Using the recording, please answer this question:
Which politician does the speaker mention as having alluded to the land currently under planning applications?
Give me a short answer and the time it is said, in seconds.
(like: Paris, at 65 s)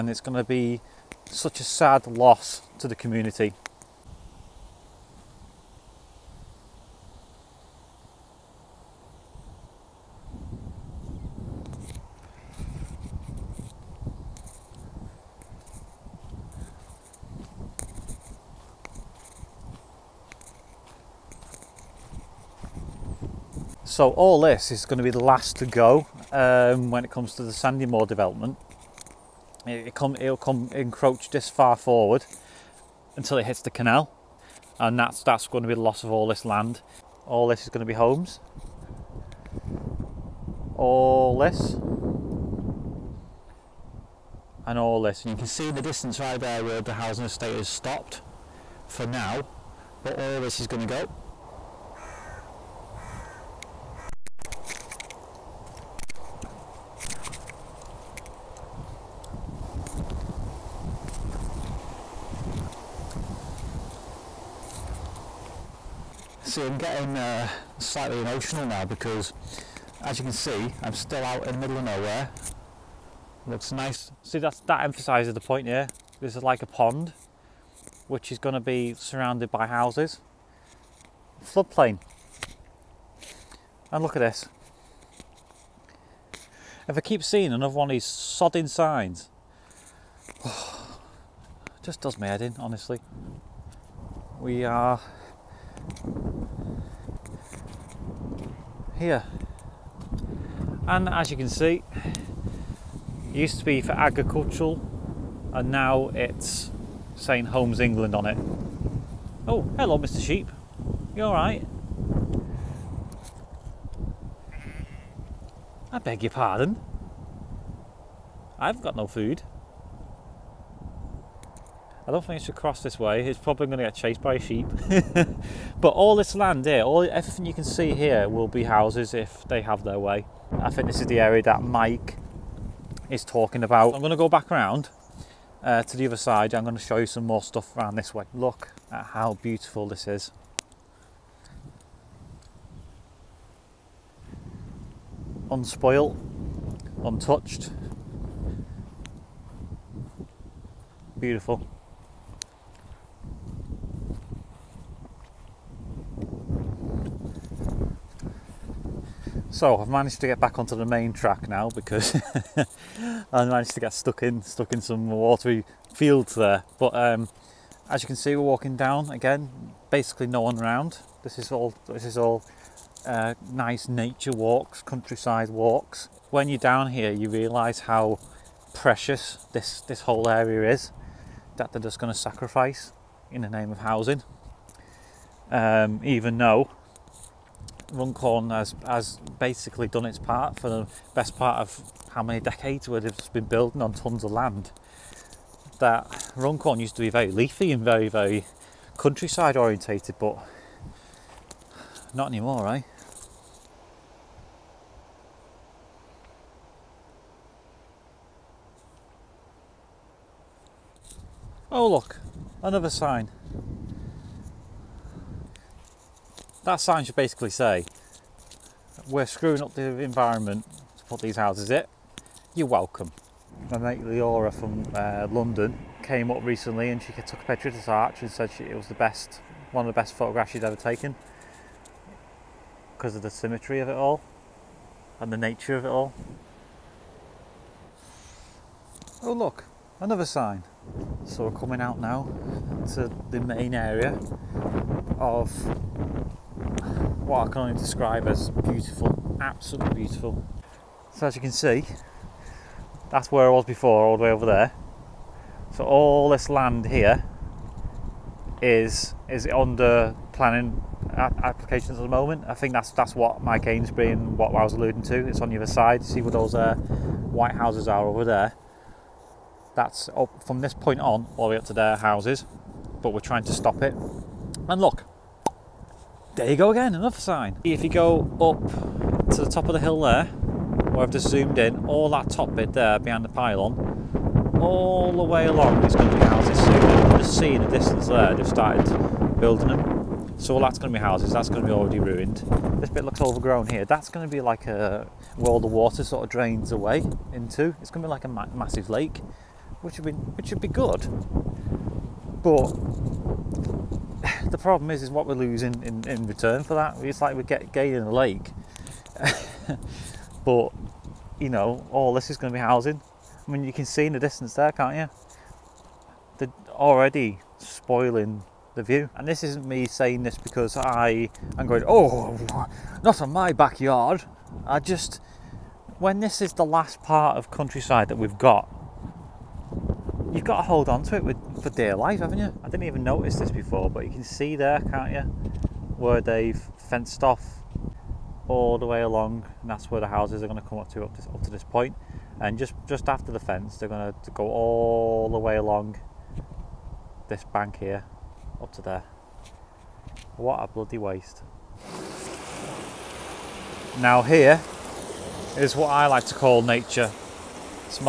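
Mike Amesbury, at 263 s.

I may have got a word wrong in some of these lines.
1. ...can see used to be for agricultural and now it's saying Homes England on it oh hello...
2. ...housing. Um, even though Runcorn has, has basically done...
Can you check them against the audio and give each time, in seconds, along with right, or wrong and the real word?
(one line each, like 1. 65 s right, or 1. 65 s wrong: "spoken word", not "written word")
1. 101 s right
2. 183 s right.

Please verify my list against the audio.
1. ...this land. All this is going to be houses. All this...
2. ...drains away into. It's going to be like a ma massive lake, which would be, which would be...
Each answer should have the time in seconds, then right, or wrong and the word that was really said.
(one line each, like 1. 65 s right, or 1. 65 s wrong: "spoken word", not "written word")
1. 36 s wrong: "homes", not "houses"
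2. 296 s right.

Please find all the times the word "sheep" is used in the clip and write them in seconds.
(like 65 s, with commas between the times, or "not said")
110 s, 124 s.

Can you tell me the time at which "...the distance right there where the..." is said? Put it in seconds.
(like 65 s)
45 s.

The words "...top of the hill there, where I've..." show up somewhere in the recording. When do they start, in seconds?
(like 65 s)
279 s.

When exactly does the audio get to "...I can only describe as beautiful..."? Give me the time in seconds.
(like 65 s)
247 s.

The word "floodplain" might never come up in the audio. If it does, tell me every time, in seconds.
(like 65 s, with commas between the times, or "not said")
81 s.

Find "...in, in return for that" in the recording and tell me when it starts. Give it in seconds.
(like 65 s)
305 s.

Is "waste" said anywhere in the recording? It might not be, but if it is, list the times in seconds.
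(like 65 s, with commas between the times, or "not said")
350 s.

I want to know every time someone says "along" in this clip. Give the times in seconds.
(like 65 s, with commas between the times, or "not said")
285 s, 339 s, 345 s.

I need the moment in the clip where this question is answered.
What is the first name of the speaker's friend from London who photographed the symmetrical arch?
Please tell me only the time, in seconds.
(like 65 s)
224 s.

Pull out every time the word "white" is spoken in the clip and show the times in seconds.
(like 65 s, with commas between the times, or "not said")
266 s.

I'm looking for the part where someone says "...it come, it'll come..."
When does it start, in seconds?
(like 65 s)
29 s.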